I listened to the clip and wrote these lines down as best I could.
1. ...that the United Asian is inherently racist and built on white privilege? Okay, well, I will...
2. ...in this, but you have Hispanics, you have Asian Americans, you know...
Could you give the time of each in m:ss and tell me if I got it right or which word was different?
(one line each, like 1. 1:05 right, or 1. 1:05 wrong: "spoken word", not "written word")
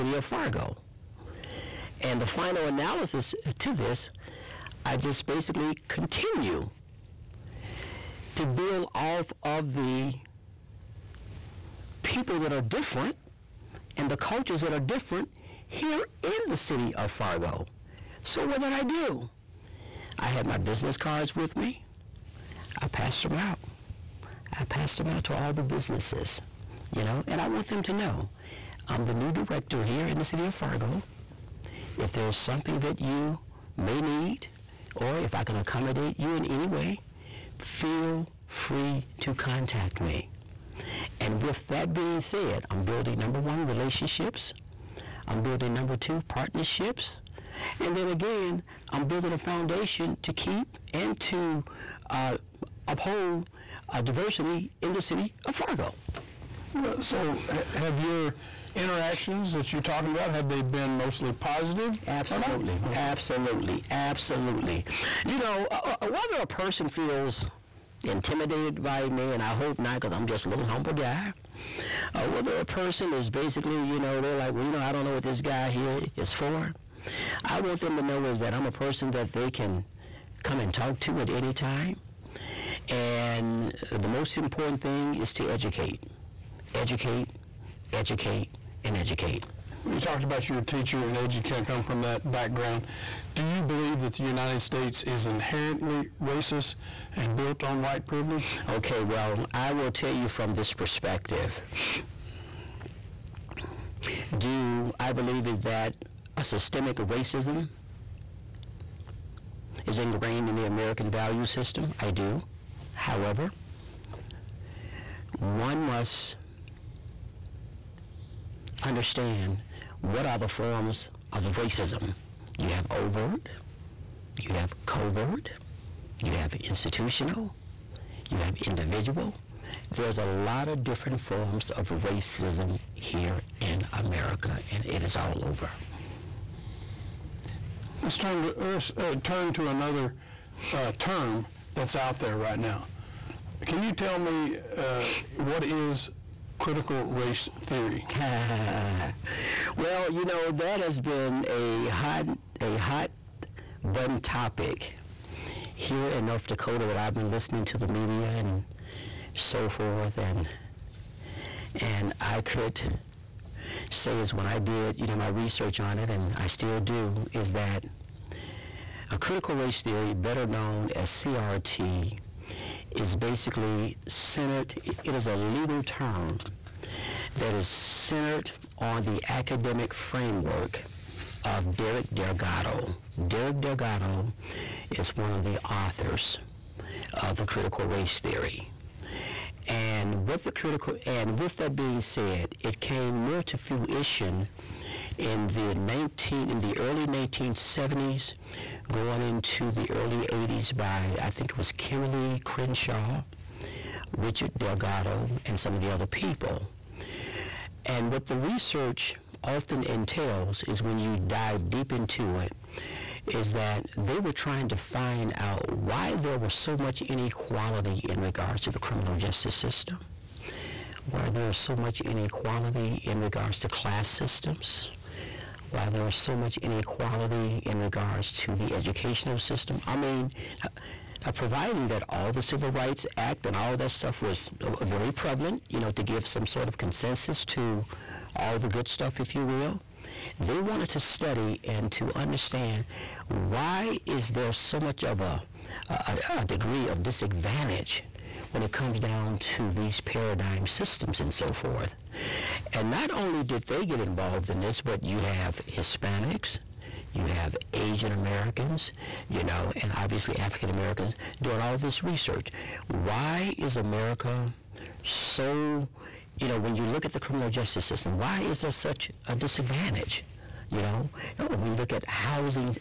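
1. 1:34 wrong: "States", not "Asian"
2. 4:14 right.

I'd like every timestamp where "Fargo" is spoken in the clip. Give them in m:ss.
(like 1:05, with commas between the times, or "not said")
0:00, 0:17, 0:30, 0:55.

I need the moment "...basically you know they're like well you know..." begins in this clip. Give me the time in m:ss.
1:13.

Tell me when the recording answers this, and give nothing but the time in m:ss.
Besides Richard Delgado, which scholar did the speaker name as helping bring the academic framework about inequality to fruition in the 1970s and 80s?
3:21.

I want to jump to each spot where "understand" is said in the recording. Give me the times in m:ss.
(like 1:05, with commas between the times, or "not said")
1:58, 4:02.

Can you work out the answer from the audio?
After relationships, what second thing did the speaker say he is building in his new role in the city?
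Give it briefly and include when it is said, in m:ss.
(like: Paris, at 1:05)
partnerships, at 0:46.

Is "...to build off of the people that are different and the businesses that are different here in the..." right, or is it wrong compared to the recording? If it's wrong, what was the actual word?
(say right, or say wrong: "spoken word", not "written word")
wrong: "cultures", not "businesses".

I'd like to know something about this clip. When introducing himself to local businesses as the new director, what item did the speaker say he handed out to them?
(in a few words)
business cards.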